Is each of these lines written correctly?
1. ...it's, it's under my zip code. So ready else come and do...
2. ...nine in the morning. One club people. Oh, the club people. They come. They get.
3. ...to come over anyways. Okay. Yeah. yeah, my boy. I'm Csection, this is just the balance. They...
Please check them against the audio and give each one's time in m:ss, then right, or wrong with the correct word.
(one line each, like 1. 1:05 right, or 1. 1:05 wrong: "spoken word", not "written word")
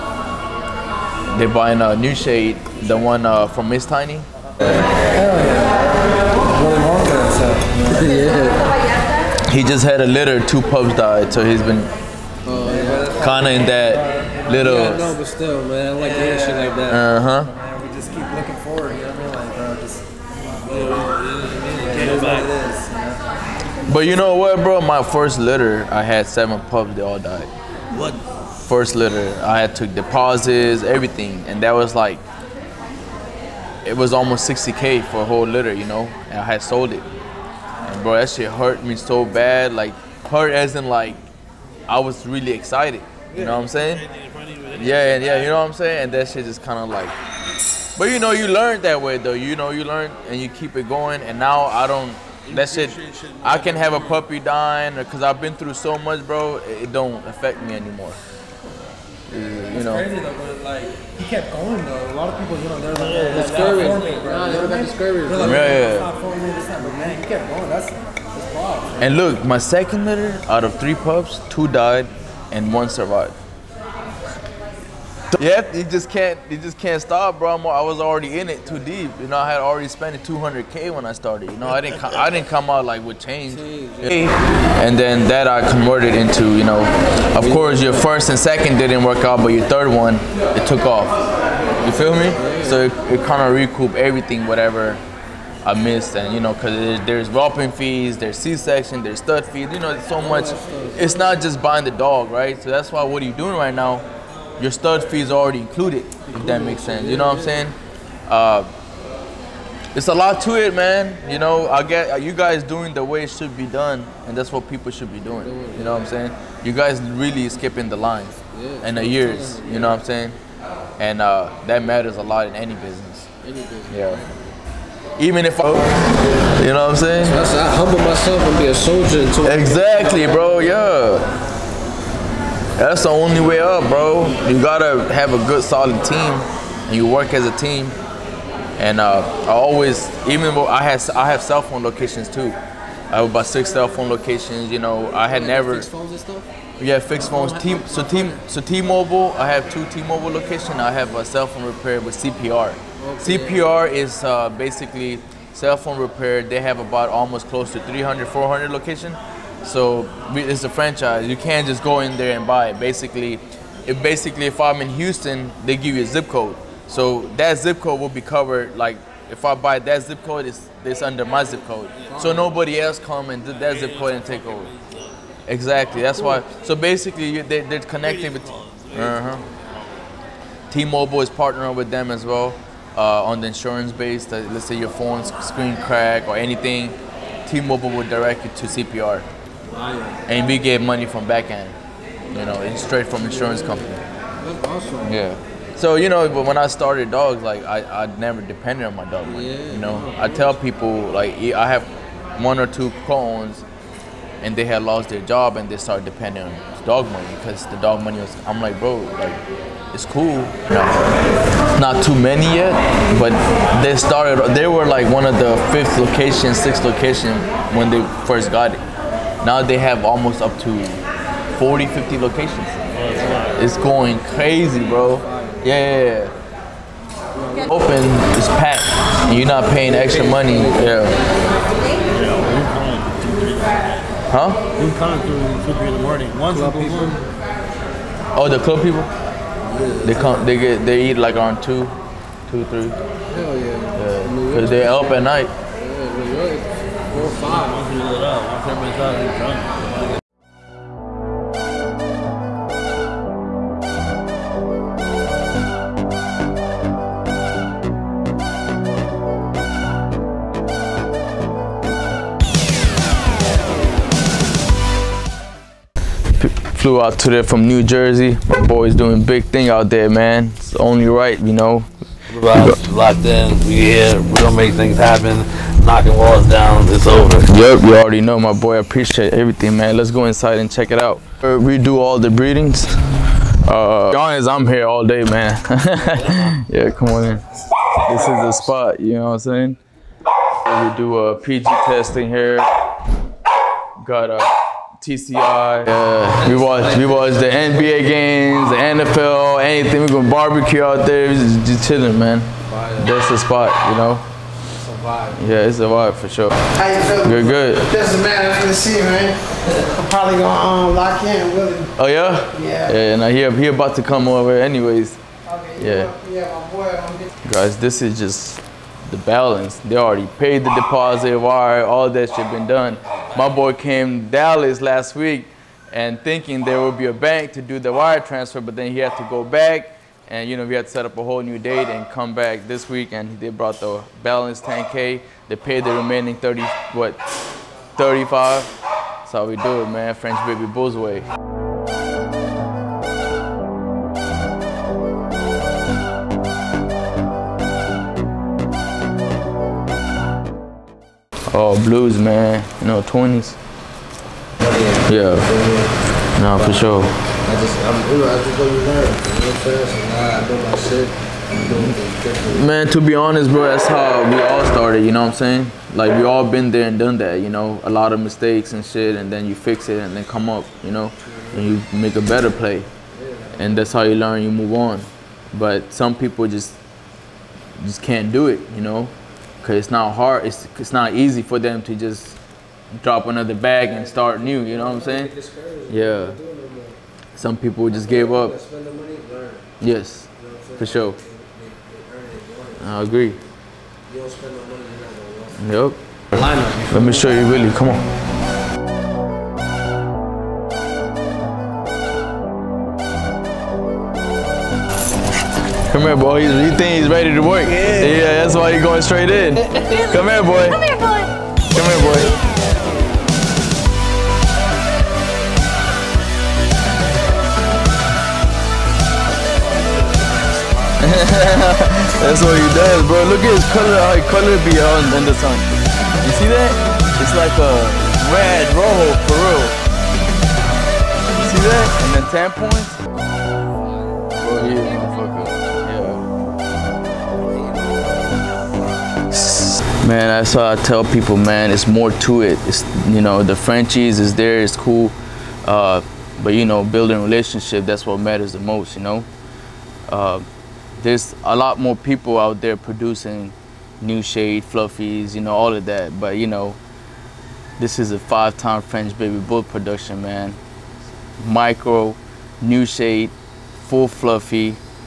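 1. 2:50 wrong: "nobody", not "ready"
2. 3:55 wrong: "three", not "nine"
3. 5:13 wrong: "Guys", not "Csection".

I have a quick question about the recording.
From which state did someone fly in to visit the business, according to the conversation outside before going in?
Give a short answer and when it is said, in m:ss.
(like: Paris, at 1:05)
New Jersey, at 4:27.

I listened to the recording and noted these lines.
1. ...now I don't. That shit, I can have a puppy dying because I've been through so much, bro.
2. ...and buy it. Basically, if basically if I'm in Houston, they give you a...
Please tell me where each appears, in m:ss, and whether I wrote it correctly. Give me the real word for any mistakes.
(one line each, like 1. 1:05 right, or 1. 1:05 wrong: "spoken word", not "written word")
1. 0:51 right
2. 2:42 right.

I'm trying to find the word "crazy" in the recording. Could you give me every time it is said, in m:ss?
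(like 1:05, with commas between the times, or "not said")
0:59, 3:44.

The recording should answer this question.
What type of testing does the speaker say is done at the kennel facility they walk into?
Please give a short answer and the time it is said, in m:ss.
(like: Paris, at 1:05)
PG testing, at 4:51.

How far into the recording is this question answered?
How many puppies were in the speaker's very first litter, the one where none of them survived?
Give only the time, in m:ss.
0:26.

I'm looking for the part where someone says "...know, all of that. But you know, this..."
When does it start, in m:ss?
7:35.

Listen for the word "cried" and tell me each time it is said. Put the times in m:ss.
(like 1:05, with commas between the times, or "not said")
not said.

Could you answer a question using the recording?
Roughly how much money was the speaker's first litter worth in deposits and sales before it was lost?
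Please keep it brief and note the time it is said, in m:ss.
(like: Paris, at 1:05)
60k, at 0:34.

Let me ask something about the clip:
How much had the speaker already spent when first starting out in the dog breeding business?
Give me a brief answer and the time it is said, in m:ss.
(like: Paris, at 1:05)
200k, at 1:20.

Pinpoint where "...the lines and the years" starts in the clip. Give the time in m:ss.
1:57.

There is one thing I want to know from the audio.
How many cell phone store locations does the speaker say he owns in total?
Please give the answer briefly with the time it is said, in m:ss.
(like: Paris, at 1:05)
6, at 2:23.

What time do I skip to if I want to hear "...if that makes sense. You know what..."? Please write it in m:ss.
1:46.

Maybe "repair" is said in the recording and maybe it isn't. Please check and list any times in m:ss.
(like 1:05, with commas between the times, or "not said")
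2:31, 2:35.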